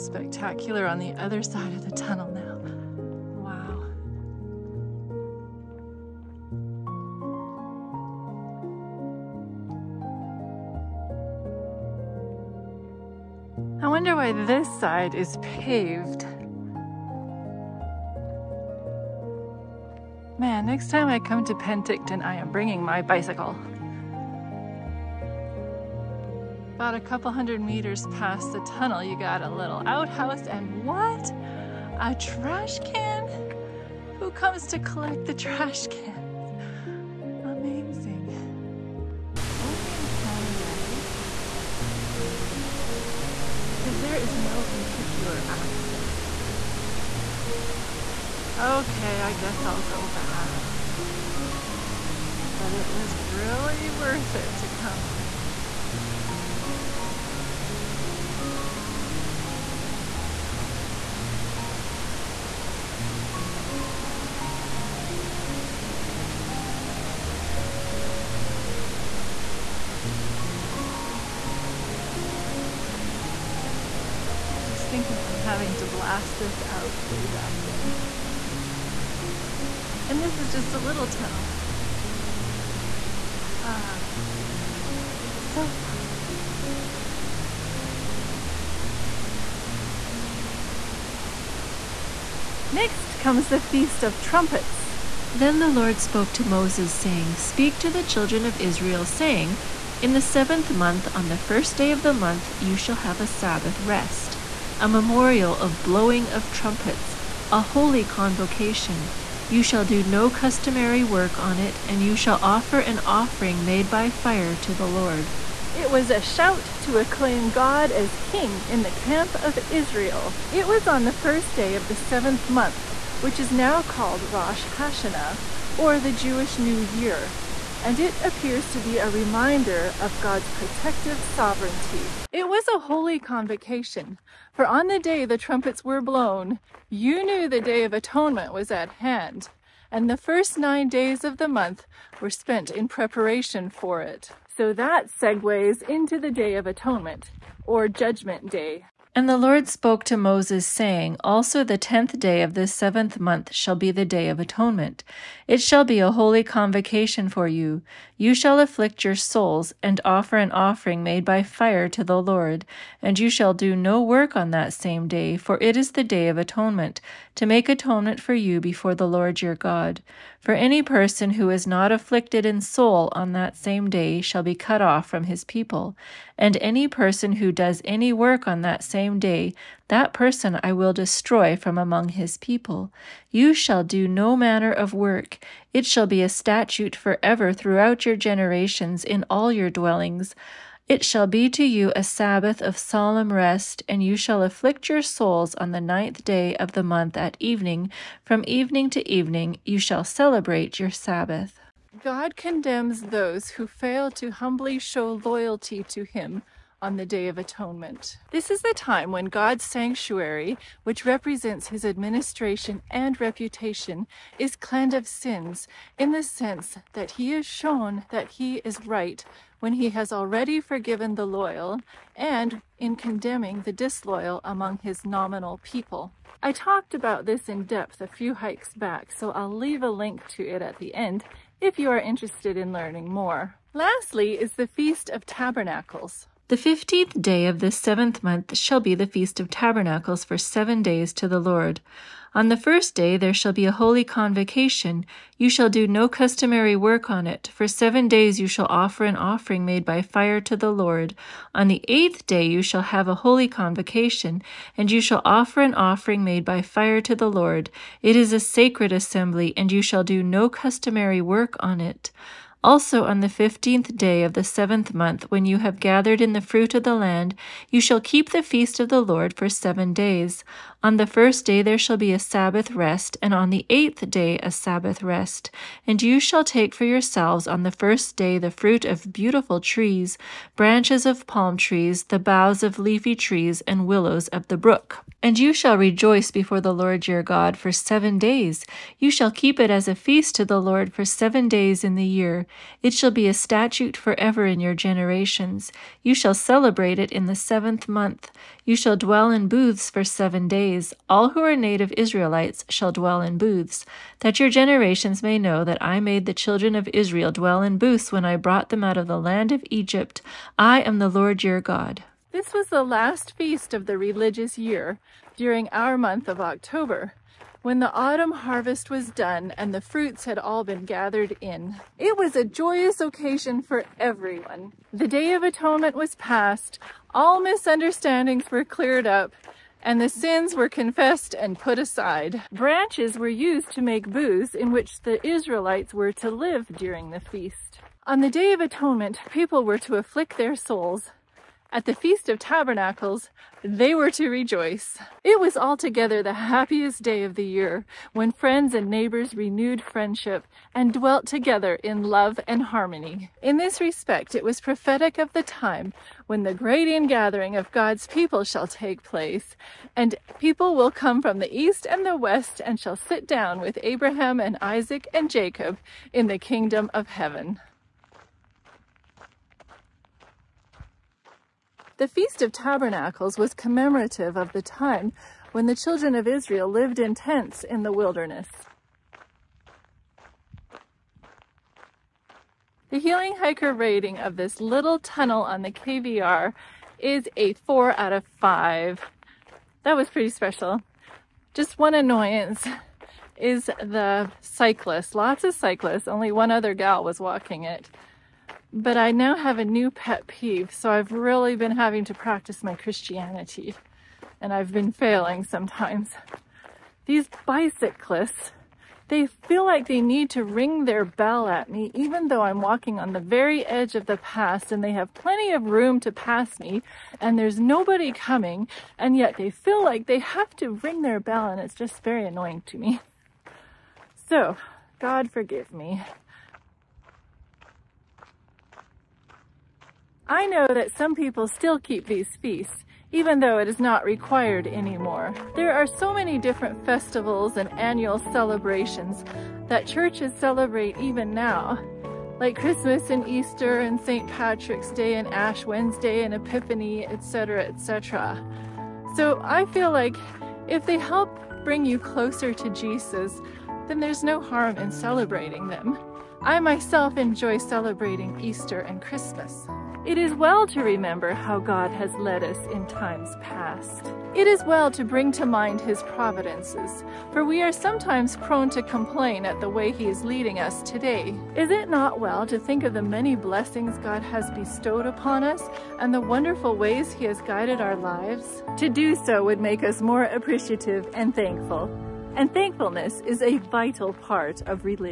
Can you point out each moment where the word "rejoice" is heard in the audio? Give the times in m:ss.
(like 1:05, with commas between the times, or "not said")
4:45, 5:44.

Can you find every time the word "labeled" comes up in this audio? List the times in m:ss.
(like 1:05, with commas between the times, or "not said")
not said.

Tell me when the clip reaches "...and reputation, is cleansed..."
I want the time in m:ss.
3:32.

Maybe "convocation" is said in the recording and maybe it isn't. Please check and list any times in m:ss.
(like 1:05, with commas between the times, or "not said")
1:48, 2:13, 2:36, 4:04, 4:13.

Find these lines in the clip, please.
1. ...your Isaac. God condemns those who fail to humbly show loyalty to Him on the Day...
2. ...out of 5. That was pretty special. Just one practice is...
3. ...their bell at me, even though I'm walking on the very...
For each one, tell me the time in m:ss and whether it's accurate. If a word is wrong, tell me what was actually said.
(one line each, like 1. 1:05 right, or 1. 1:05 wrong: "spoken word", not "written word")
1. 3:20 wrong: "Sabbath", not "Isaac"
2. 6:27 wrong: "annoyance", not "practice"
3. 6:50 right.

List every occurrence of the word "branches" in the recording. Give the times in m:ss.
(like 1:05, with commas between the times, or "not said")
4:40, 5:32.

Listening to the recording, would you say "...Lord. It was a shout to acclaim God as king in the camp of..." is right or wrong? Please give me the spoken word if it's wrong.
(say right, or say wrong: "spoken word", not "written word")
right.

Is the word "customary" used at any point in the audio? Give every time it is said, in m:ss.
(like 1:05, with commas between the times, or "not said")
1:50, 4:06, 4:20.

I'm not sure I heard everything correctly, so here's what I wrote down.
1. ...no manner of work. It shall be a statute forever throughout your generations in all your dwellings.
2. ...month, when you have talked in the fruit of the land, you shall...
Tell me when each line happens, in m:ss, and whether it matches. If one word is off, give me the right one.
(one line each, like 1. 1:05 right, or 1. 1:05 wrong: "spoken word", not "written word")
1. 3:04 right
2. 4:24 wrong: "gathered", not "talked".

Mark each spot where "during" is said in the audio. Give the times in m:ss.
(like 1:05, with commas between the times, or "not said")
5:15, 5:36.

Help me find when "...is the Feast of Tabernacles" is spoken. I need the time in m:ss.
3:54.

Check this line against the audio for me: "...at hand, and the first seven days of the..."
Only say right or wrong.
wrong.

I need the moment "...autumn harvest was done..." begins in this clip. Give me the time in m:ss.
5:17.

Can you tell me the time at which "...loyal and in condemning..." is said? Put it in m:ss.
3:41.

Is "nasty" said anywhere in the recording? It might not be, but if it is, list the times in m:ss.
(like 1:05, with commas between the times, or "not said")
not said.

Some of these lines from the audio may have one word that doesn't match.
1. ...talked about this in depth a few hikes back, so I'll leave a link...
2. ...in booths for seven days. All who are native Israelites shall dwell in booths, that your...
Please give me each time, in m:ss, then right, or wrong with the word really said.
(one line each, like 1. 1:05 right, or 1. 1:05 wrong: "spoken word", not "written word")
1. 3:46 right
2. 4:59 right.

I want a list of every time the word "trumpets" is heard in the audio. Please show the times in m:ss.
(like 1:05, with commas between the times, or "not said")
1:34, 1:46, 2:15.